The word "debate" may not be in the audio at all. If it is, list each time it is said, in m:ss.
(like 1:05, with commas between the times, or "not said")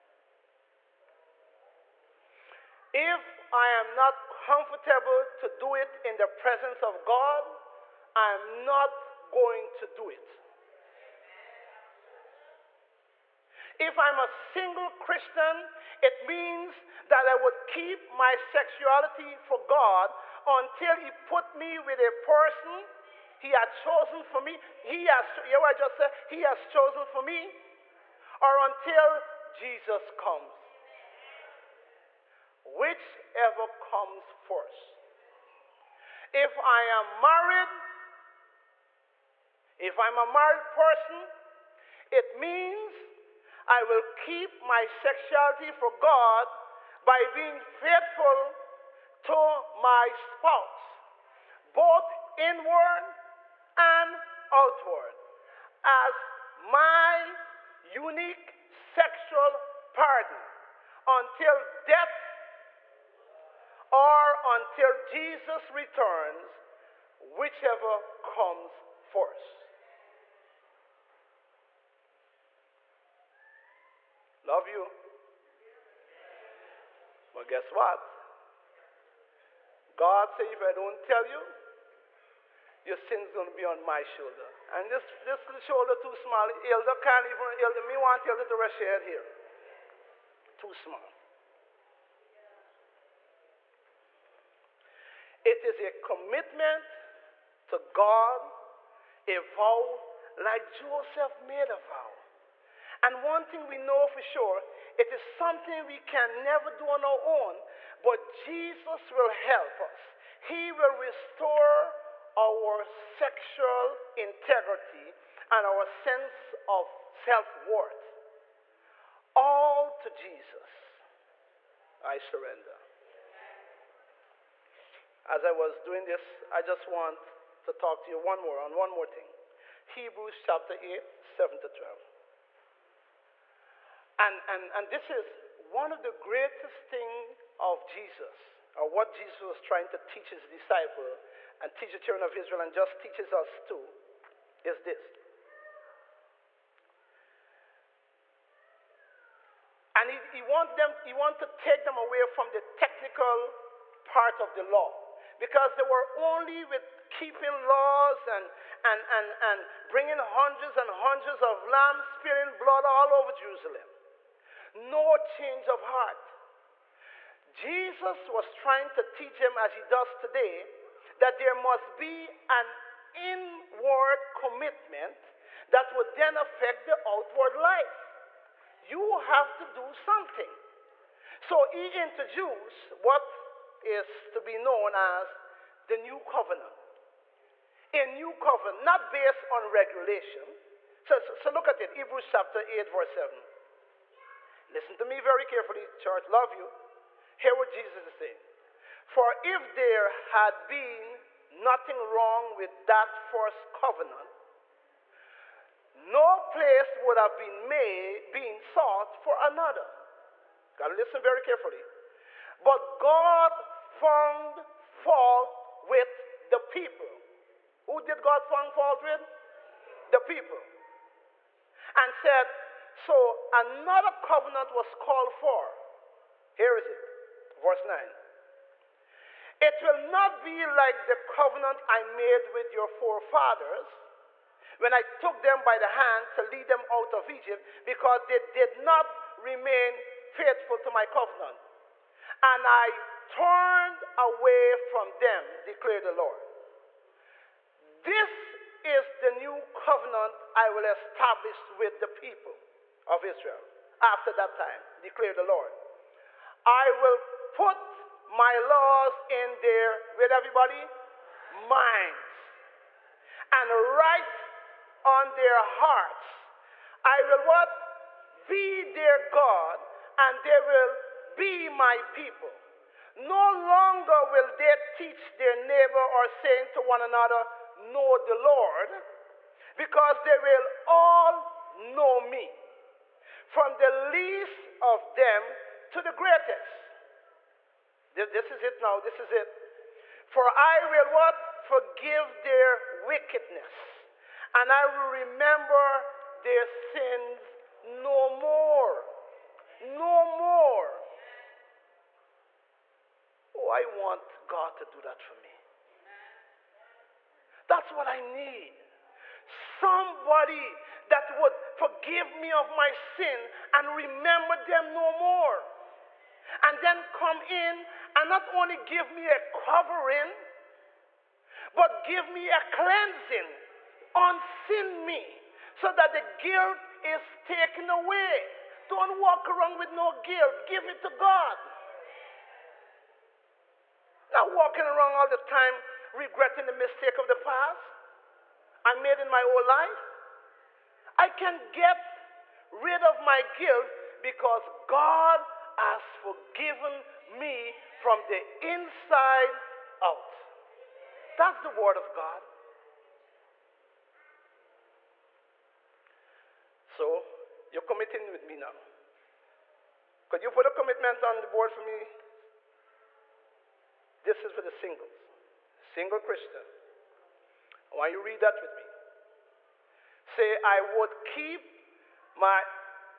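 not said.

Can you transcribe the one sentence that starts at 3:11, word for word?
So, so look at it, Hebrews chapter 8, verse 7.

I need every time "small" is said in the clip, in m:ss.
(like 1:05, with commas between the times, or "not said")
1:26, 1:30.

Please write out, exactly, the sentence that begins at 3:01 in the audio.
So he introduced what is to be known as the New Covenant.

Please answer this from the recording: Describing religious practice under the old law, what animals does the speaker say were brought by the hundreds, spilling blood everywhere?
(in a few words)
lambs.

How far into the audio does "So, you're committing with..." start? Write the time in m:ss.
5:56.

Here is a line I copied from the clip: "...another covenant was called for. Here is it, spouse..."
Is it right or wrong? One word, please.
wrong.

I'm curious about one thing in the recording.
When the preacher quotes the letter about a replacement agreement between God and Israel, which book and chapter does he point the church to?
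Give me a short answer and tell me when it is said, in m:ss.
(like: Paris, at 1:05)
Hebrews chapter 8, at 2:09.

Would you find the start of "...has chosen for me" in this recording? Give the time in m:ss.
0:26.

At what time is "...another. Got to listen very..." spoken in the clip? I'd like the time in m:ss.
3:29.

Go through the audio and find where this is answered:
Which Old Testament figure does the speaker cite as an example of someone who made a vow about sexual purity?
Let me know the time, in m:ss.
1:40.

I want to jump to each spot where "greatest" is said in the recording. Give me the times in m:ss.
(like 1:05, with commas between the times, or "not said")
2:16, 4:46.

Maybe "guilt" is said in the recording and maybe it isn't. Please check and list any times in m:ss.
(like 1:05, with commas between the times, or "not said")
5:26, 5:30, 5:43.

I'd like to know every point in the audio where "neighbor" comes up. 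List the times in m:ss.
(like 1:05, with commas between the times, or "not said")
4:35.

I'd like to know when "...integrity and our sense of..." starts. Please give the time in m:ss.
1:54.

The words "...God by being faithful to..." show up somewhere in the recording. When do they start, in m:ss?
0:45.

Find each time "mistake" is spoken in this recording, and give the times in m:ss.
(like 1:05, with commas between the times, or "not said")
5:36.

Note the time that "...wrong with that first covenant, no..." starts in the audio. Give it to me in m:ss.
3:22.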